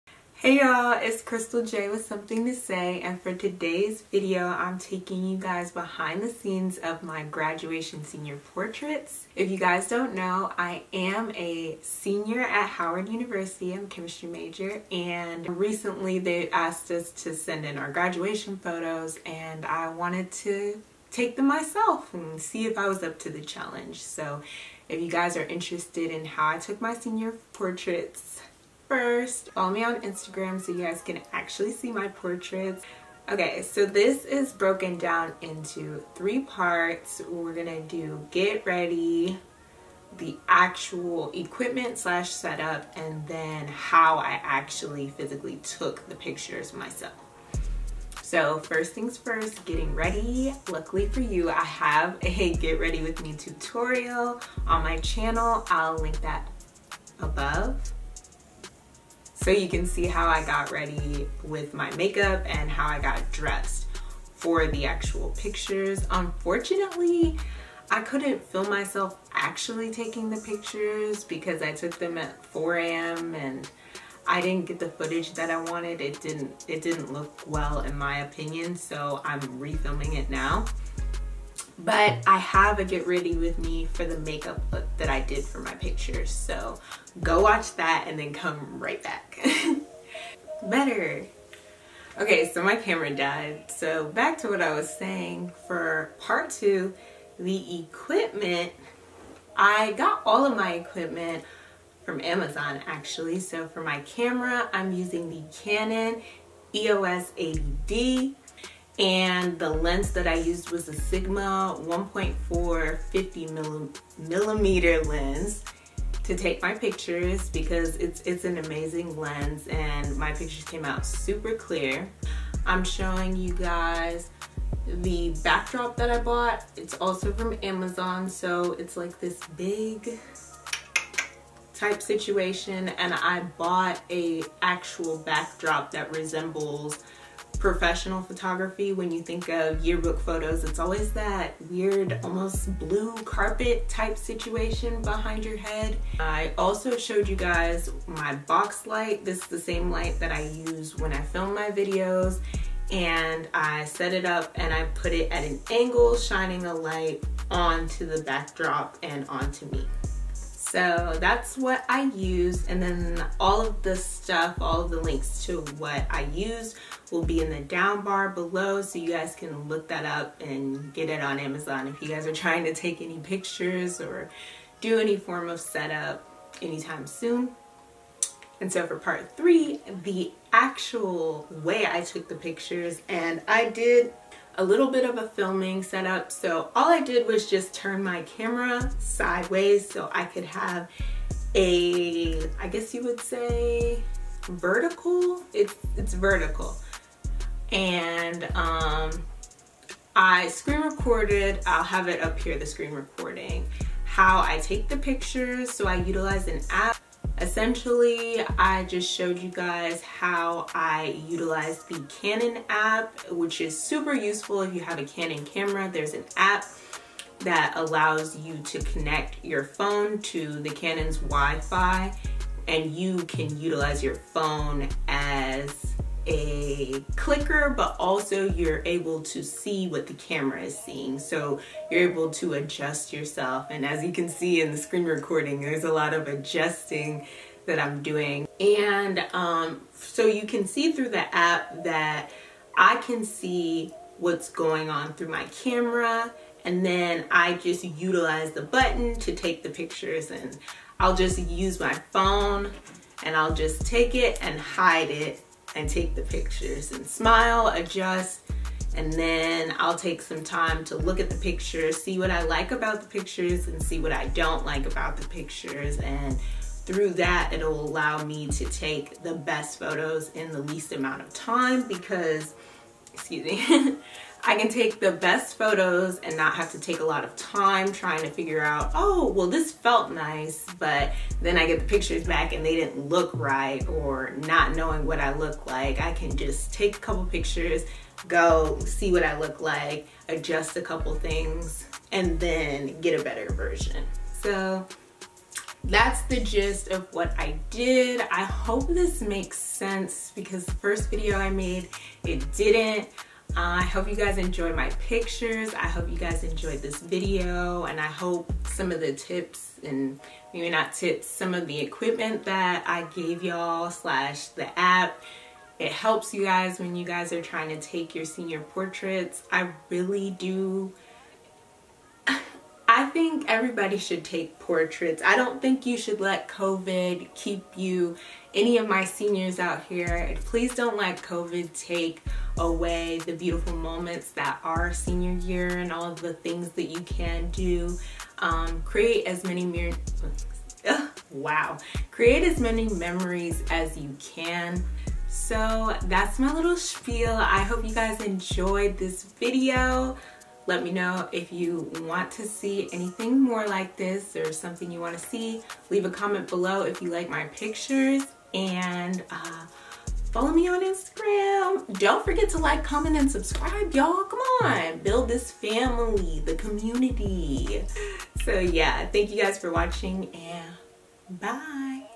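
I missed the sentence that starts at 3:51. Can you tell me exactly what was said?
So you're able to adjust yourself.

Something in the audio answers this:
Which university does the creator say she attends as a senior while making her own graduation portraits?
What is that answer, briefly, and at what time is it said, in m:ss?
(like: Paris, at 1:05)
Howard University, at 0:12.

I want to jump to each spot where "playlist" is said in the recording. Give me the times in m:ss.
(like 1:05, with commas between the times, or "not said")
not said.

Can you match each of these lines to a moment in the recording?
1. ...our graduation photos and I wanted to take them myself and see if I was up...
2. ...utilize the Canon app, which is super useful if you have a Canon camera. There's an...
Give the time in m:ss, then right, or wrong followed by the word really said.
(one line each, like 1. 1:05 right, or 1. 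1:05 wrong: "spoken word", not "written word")
1. 0:17 right
2. 3:31 right.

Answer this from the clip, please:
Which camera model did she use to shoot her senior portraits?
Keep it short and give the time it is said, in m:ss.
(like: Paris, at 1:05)
Canon EOS 80D, at 1:45.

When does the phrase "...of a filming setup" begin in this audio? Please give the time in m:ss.
3:05.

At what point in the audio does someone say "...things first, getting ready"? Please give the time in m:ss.
0:48.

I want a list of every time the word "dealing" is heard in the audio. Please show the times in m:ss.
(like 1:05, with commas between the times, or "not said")
not said.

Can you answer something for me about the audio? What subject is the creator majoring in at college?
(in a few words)
Chemistry.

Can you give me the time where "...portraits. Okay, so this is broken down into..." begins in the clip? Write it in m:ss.
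0:32.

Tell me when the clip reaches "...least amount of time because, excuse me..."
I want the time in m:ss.
4:30.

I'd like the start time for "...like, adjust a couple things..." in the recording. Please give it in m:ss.
4:49.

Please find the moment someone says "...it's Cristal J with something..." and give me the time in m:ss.
0:00.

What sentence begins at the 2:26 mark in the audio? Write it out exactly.
I also showed you guys my box light.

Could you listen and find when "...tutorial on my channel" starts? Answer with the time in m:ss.
0:53.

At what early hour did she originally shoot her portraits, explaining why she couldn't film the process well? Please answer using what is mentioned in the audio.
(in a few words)
4 a.m.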